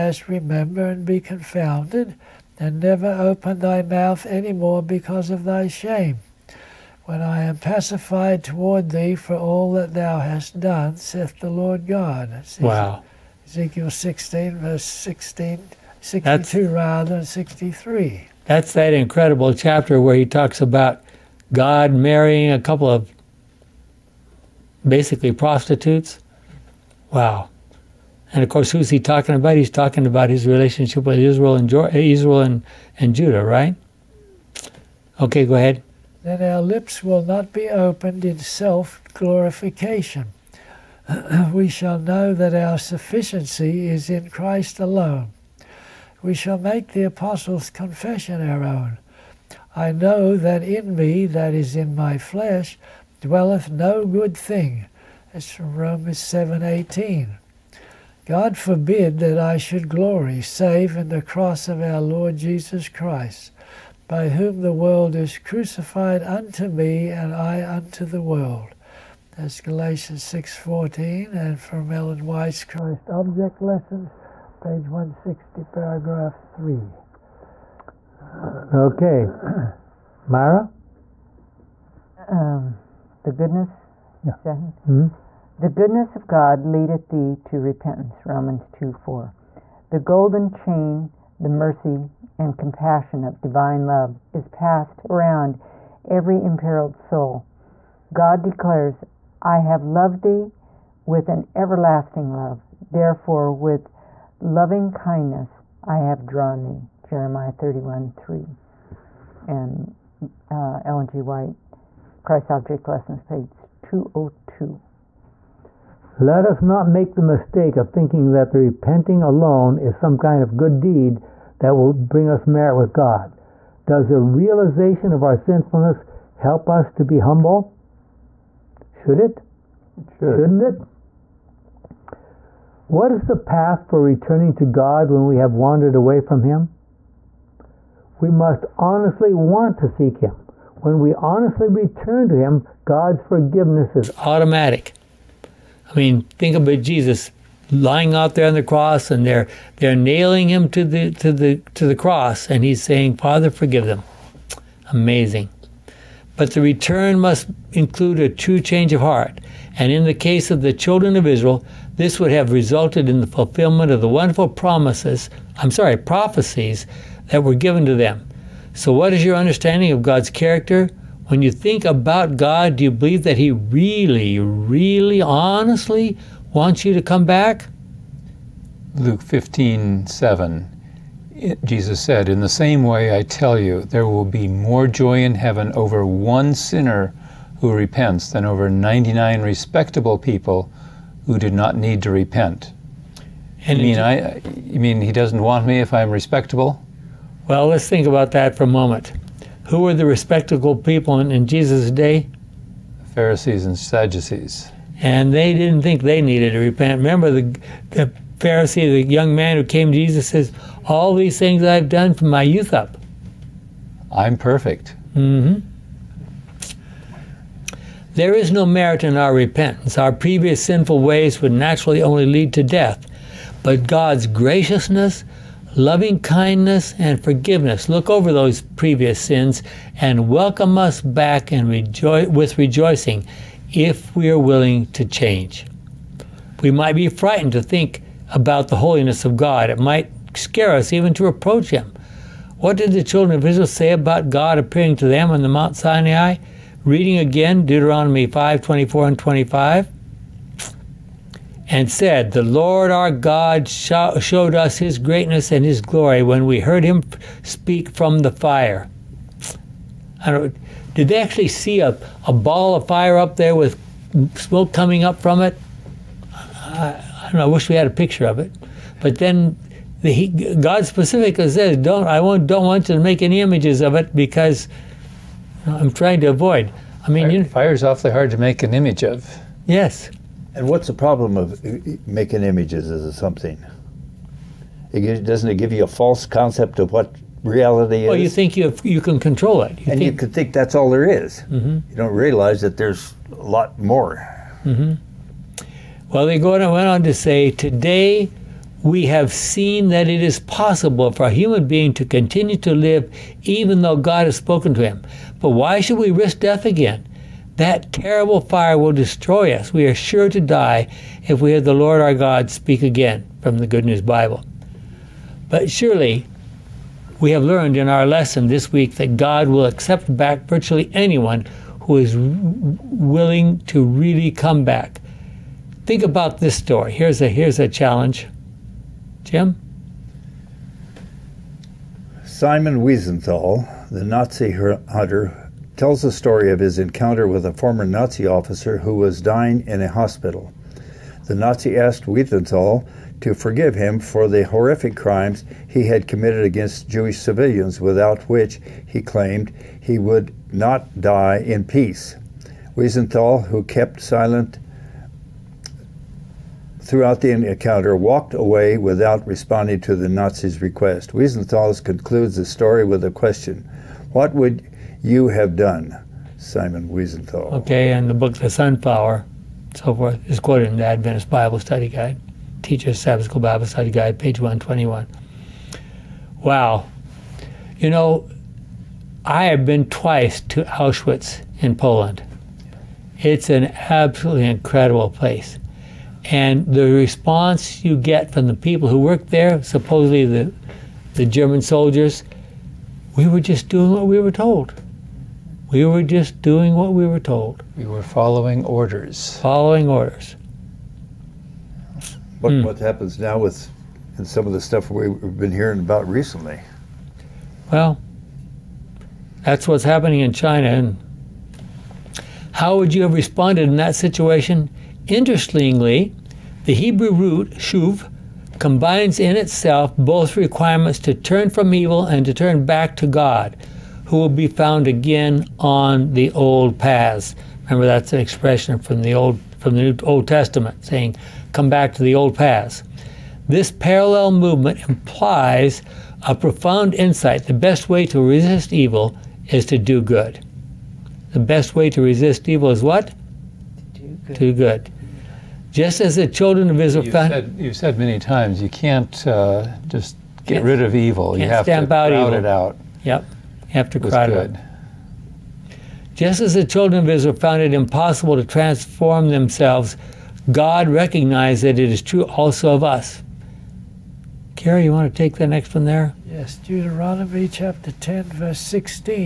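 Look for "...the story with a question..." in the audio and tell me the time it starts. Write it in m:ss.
6:02.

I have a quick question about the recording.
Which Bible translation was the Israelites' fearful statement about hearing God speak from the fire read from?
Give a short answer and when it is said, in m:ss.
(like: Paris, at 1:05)
Good News Bible, at 5:13.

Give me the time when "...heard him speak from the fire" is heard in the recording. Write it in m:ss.
4:16.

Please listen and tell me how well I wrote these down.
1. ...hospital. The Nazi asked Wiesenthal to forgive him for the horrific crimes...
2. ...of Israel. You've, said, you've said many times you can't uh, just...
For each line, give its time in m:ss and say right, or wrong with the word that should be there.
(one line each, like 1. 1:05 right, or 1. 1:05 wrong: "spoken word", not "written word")
1. 5:39 right
2. 7:26 right.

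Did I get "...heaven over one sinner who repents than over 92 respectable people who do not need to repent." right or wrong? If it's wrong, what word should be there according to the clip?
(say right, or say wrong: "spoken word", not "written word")
wrong: "99", not "92".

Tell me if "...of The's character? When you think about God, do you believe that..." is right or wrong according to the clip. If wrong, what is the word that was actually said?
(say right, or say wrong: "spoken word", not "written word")
wrong: "God", not "The".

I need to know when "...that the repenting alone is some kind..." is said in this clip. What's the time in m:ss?
1:58.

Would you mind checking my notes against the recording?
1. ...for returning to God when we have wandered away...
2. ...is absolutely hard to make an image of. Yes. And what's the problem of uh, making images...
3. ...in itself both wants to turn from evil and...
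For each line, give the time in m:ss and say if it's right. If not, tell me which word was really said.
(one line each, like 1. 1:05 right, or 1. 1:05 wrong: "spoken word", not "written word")
1. 2:13 right
2. 4:37 wrong: "awfully", not "absolutely"
3. 6:59 wrong: "requirements", not "wants".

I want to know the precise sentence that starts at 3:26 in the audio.
Remember the, the Pharisee, the young man who came to Jesus says, all these things I've done from my youth up.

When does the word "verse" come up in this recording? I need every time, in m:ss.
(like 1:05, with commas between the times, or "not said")
0:14, 7:48.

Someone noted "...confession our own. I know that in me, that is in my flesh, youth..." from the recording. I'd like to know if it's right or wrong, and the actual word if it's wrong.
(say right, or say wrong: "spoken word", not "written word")
wrong: "dwelleth", not "youth".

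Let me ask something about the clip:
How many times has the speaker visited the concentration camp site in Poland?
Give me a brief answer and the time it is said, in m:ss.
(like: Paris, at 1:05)
2, at 6:19.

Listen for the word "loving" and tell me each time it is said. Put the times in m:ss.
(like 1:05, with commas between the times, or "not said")
1:44, 3:45.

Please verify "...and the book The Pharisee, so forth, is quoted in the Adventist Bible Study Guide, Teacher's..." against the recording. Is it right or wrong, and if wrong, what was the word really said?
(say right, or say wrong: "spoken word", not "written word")
wrong: "Sunflower", not "Pharisee".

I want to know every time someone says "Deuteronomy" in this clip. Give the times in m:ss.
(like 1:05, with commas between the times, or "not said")
4:07, 7:46.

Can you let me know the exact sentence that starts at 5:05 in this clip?
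But why should we risk death again?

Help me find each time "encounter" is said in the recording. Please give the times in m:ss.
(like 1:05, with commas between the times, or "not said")
5:36, 5:57.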